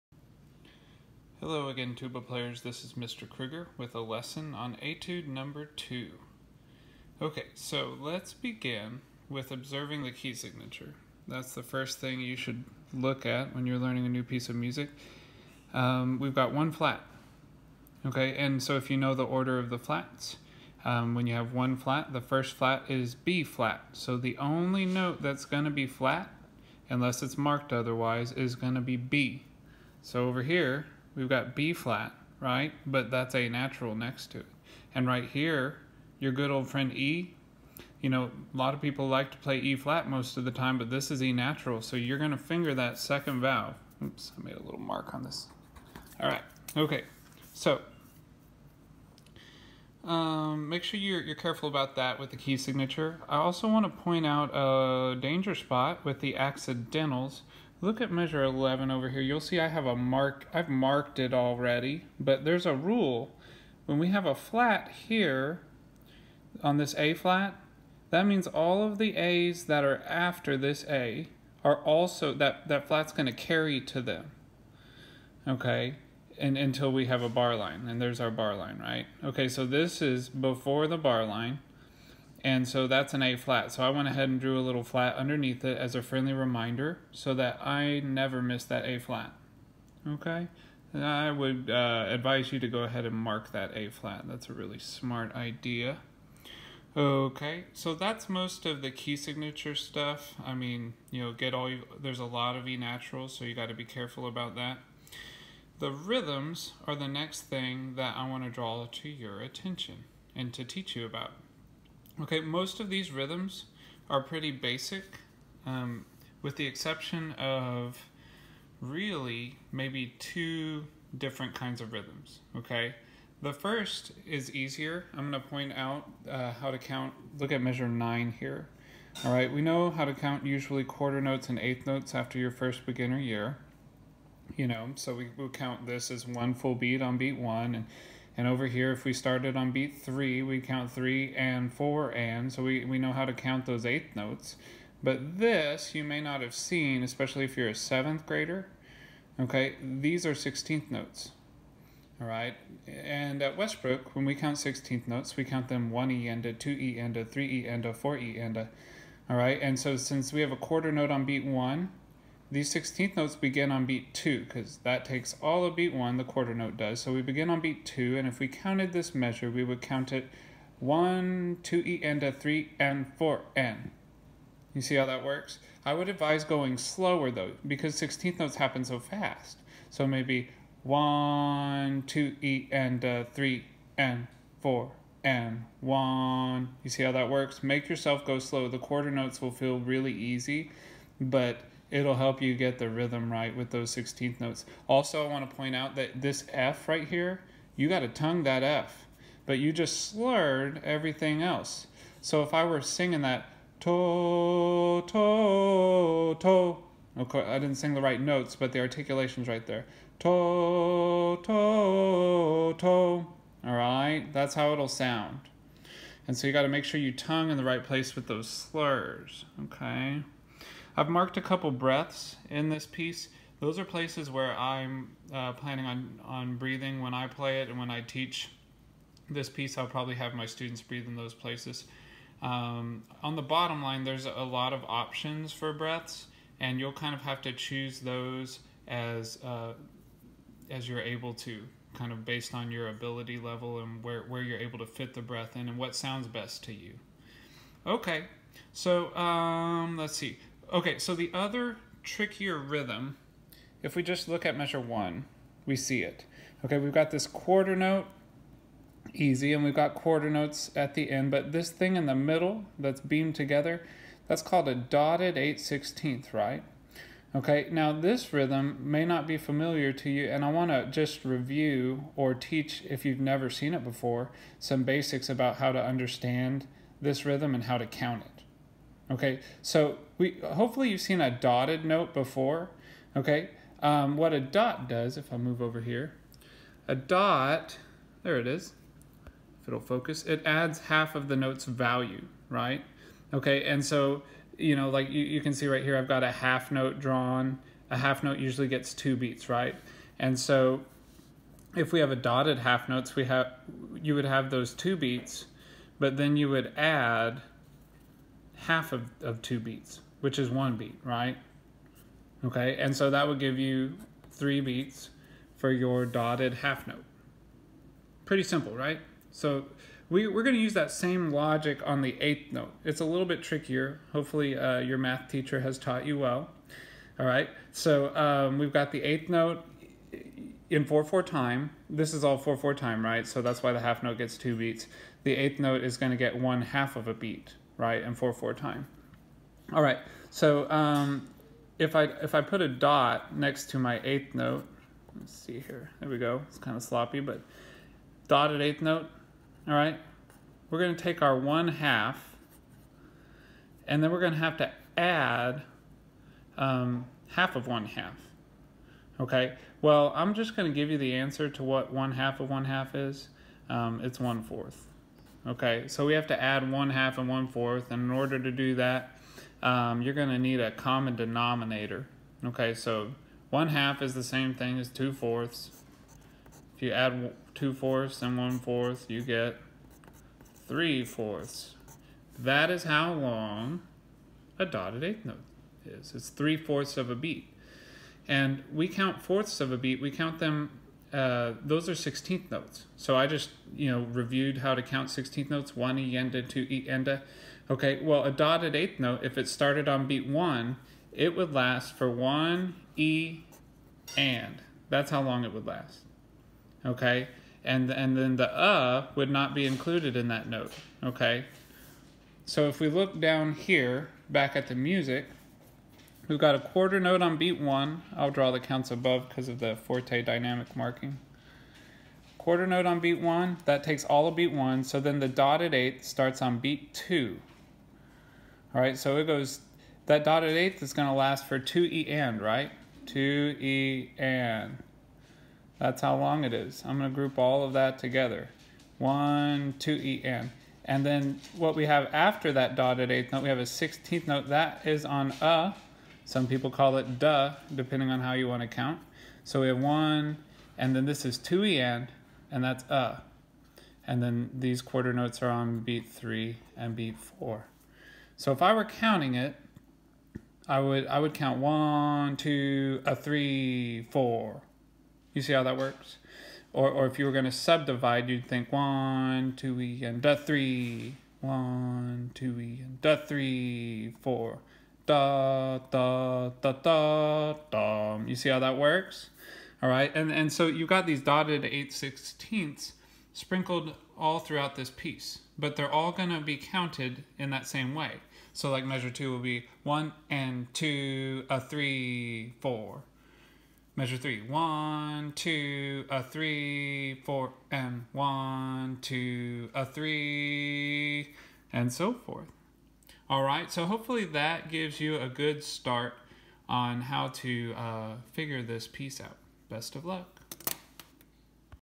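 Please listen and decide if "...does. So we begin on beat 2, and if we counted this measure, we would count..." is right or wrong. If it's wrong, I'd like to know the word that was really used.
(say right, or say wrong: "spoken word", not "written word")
right.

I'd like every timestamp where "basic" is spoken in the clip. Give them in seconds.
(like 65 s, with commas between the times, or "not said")
114 s, 274 s.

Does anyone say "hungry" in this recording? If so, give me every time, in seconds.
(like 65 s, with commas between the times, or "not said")
not said.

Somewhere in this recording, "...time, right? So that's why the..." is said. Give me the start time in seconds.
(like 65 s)
332 s.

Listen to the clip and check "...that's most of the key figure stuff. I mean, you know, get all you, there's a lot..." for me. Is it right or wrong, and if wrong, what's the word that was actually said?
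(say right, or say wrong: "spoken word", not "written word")
wrong: "signature", not "figure".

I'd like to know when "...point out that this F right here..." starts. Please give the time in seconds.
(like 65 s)
195 s.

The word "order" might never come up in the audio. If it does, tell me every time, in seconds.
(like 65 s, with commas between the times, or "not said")
19 s, 368 s.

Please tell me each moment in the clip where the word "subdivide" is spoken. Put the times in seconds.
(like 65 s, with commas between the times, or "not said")
467 s.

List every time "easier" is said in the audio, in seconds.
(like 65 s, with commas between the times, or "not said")
124 s.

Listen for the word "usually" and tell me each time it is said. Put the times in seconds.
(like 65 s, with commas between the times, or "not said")
130 s, 298 s.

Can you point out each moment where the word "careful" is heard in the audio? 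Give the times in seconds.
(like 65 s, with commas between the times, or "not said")
51 s, 103 s.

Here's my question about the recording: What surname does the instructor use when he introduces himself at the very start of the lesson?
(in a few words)
Krueger.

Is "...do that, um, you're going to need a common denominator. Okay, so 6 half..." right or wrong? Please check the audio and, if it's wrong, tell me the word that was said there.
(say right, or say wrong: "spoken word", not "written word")
wrong: "1", not "6".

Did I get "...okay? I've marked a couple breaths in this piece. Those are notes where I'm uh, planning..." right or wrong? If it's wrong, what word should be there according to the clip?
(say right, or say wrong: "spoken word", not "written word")
wrong: "places", not "notes".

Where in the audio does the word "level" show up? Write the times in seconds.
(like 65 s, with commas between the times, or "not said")
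243 s.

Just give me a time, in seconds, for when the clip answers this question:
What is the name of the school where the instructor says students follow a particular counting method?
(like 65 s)
153 s.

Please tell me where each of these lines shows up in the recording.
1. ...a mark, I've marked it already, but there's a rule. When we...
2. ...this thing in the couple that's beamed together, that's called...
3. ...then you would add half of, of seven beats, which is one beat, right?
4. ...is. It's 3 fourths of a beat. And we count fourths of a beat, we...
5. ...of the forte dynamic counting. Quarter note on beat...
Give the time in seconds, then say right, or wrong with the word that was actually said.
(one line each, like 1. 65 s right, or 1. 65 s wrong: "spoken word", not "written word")
1. 59 s right
2. 261 s wrong: "middle", not "couple"
3. 306 s wrong: "two", not "seven"
4. 385 s right
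5. 419 s wrong: "marking", not "counting".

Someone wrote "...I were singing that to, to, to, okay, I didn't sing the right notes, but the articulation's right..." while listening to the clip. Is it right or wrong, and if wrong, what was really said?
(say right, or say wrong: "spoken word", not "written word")
right.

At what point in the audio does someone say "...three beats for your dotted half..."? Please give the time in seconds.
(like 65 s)
314 s.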